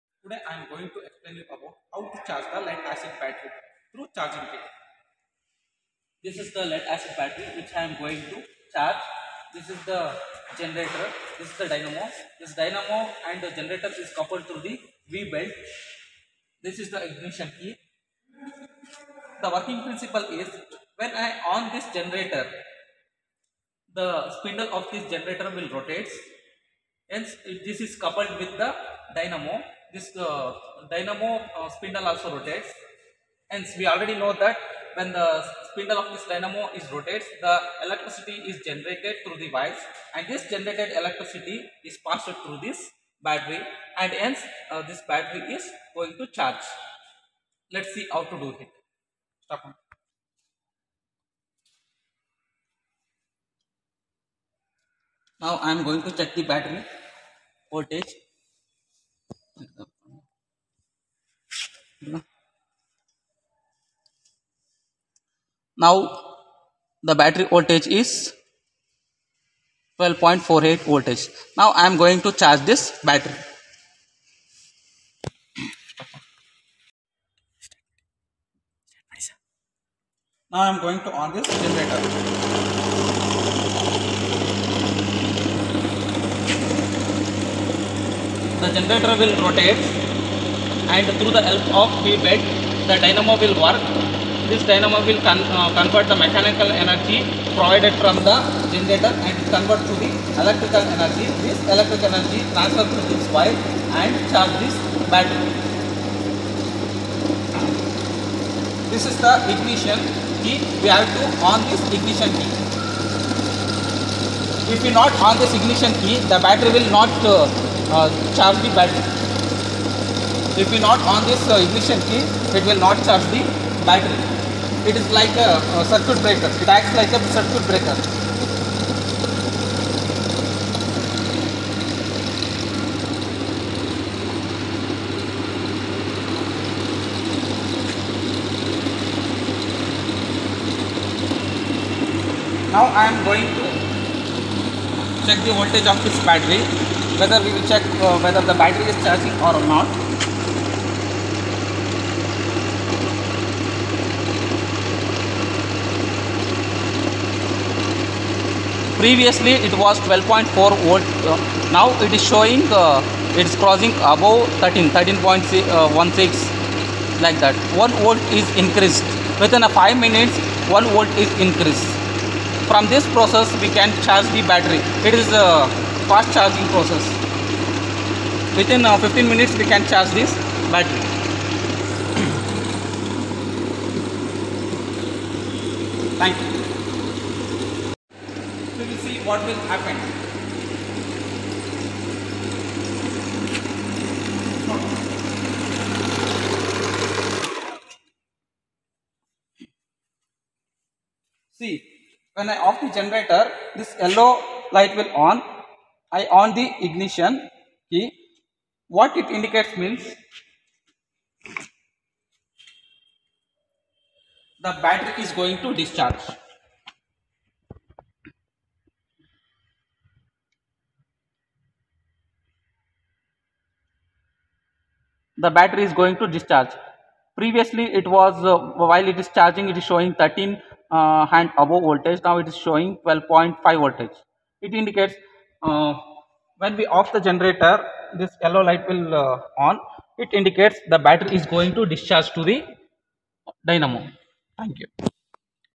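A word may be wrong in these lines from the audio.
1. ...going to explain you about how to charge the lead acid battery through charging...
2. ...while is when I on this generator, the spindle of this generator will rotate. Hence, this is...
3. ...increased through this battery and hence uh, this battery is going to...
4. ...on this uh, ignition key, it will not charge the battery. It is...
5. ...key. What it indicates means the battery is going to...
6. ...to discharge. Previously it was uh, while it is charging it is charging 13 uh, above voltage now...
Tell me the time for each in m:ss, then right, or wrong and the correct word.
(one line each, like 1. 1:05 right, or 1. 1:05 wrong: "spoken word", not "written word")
1. 0:00 right
2. 0:19 wrong: "principle", not "while"
3. 0:42 wrong: "passed", not "increased"
4. 2:01 right
5. 3:27 right
6. 3:46 wrong: "showing", not "charging".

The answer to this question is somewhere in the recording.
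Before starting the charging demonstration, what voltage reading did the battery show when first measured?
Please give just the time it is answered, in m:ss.
1:09.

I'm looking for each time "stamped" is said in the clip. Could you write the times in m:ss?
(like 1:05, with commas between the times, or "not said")
not said.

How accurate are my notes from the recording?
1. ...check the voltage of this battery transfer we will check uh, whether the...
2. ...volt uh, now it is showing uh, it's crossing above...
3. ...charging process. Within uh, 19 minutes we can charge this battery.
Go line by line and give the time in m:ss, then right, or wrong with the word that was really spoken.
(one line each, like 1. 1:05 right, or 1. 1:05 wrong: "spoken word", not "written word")
1. 2:25 wrong: "whether", not "transfer"
2. 2:40 right
3. 2:56 wrong: "15", not "19".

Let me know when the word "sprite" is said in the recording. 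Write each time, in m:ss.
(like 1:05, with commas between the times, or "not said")
not said.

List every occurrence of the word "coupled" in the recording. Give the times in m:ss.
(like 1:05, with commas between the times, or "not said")
0:14, 0:27.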